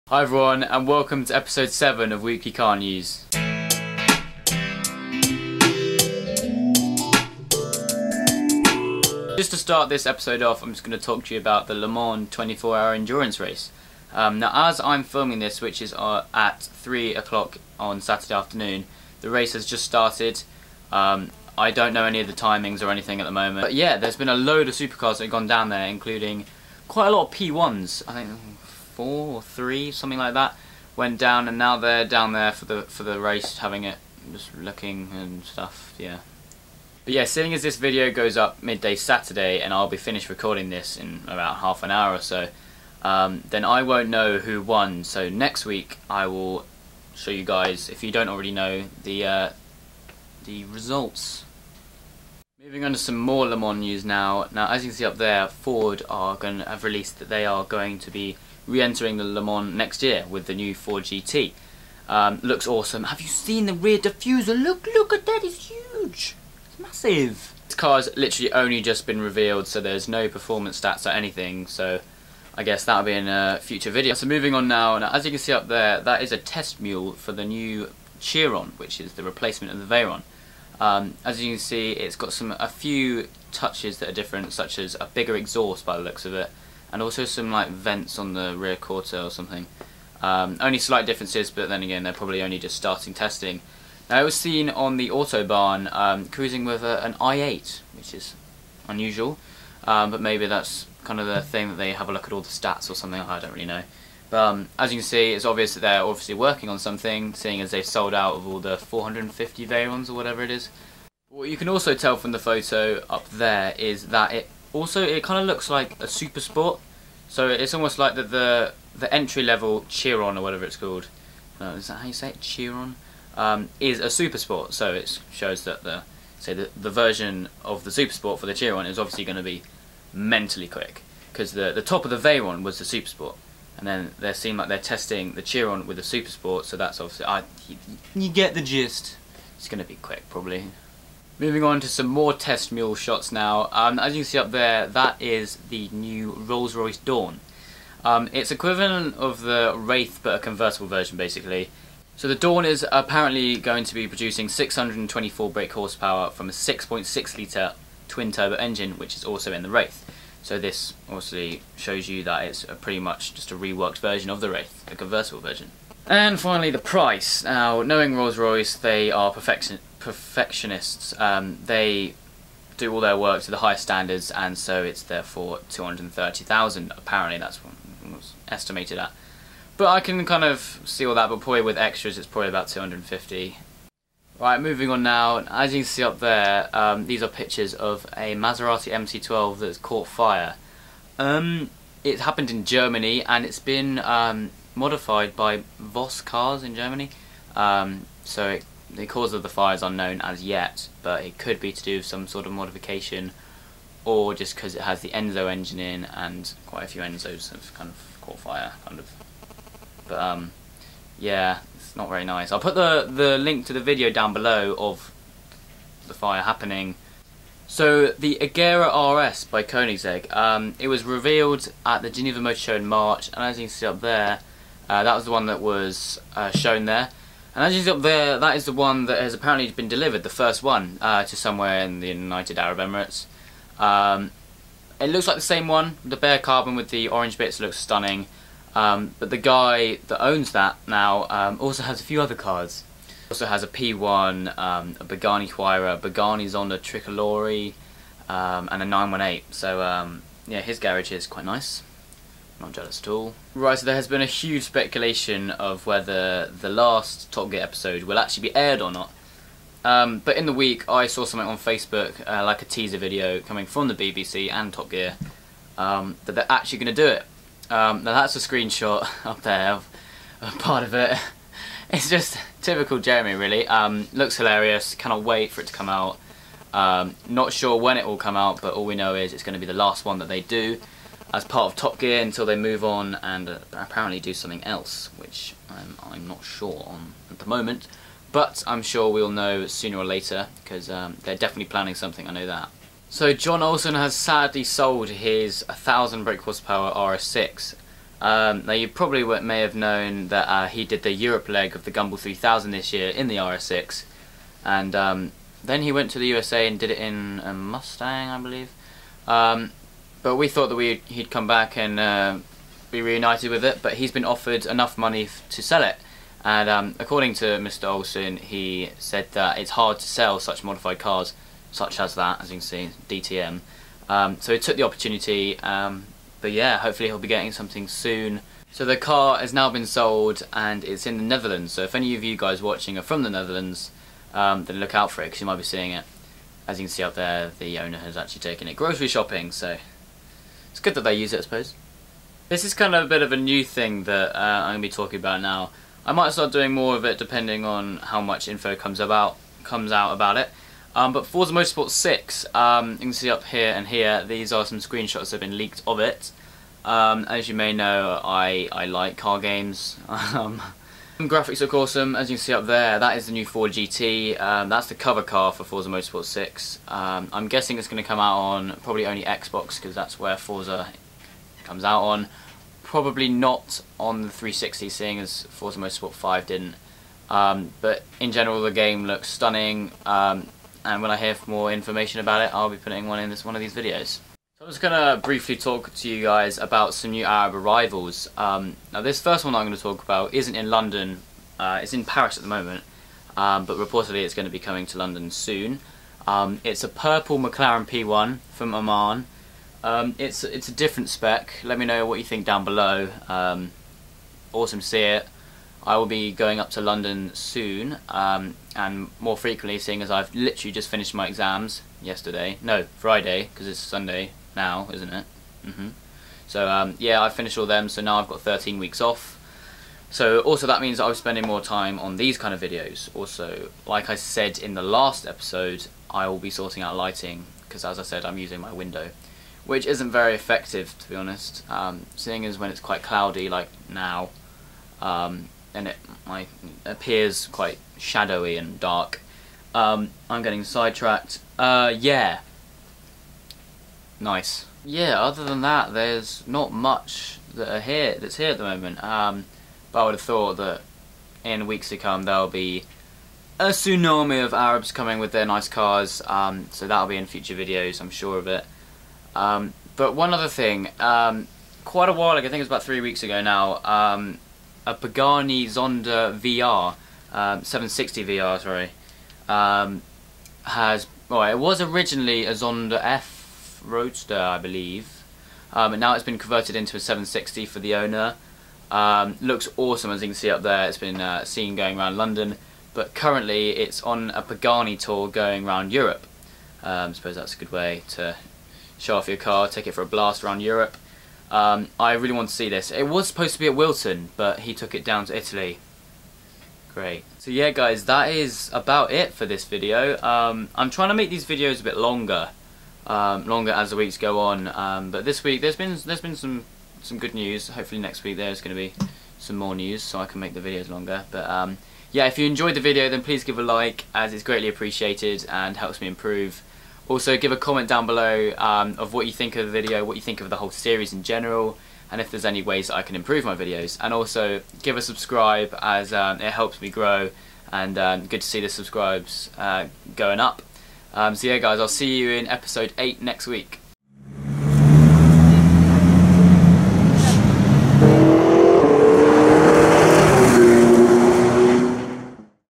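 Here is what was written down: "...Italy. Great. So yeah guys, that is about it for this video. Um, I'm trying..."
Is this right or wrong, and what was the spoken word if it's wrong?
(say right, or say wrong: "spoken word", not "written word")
right.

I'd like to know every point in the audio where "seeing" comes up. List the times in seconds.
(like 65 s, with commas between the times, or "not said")
37 s, 107 s, 335 s, 374 s, 409 s, 432 s.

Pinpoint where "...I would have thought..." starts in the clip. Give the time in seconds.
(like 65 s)
450 s.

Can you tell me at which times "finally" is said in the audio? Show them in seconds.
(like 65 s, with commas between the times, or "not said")
166 s.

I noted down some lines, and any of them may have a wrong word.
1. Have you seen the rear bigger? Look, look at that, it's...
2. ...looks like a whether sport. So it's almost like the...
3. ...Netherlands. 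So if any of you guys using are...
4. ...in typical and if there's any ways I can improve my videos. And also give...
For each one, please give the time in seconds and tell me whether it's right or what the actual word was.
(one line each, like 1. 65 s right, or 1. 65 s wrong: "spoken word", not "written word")
1. 63 s wrong: "diffuser", not "bigger"
2. 115 s wrong: "super", not "whether"
3. 331 s wrong: "watching", not "using"
4. 521 s wrong: "general", not "typical".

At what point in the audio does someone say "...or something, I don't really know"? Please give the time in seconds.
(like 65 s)
102 s.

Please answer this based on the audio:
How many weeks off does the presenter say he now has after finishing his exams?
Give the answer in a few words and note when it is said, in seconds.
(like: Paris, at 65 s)
13, at 418 s.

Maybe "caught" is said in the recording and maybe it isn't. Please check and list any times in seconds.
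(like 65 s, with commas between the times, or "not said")
189 s, 208 s.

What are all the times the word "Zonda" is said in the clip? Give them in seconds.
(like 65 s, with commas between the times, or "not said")
246 s, 465 s, 472 s.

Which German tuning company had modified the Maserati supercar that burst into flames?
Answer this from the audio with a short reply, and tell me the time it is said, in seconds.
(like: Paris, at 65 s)
Voss Cars, at 195 s.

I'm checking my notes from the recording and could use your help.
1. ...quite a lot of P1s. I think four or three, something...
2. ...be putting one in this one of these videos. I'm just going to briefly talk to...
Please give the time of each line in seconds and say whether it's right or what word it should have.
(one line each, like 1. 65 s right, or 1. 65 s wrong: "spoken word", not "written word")
1. 26 s right
2. 382 s right.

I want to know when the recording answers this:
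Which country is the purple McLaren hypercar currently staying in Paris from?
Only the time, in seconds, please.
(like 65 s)
398 s.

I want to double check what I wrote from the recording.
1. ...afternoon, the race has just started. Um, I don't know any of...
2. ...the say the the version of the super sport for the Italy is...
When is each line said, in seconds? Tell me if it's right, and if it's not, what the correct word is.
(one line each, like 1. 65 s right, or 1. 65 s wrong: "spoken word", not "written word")
1. 18 s right
2. 125 s wrong: "Chiron", not "Italy".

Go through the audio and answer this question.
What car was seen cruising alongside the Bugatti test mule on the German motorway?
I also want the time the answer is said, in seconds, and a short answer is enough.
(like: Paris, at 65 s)
i8, at 97 s.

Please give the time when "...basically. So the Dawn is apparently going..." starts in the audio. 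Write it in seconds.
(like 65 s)
151 s.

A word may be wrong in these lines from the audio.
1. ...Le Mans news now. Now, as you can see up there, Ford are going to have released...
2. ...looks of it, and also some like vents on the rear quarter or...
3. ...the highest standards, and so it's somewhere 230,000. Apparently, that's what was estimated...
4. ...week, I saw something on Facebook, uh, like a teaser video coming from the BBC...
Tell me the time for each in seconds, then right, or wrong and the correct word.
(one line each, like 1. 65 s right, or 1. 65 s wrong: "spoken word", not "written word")
1. 53 s right
2. 86 s right
3. 173 s wrong: "therefore", not "somewhere"
4. 260 s right.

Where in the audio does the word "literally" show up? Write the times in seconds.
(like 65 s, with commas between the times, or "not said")
68 s, 410 s.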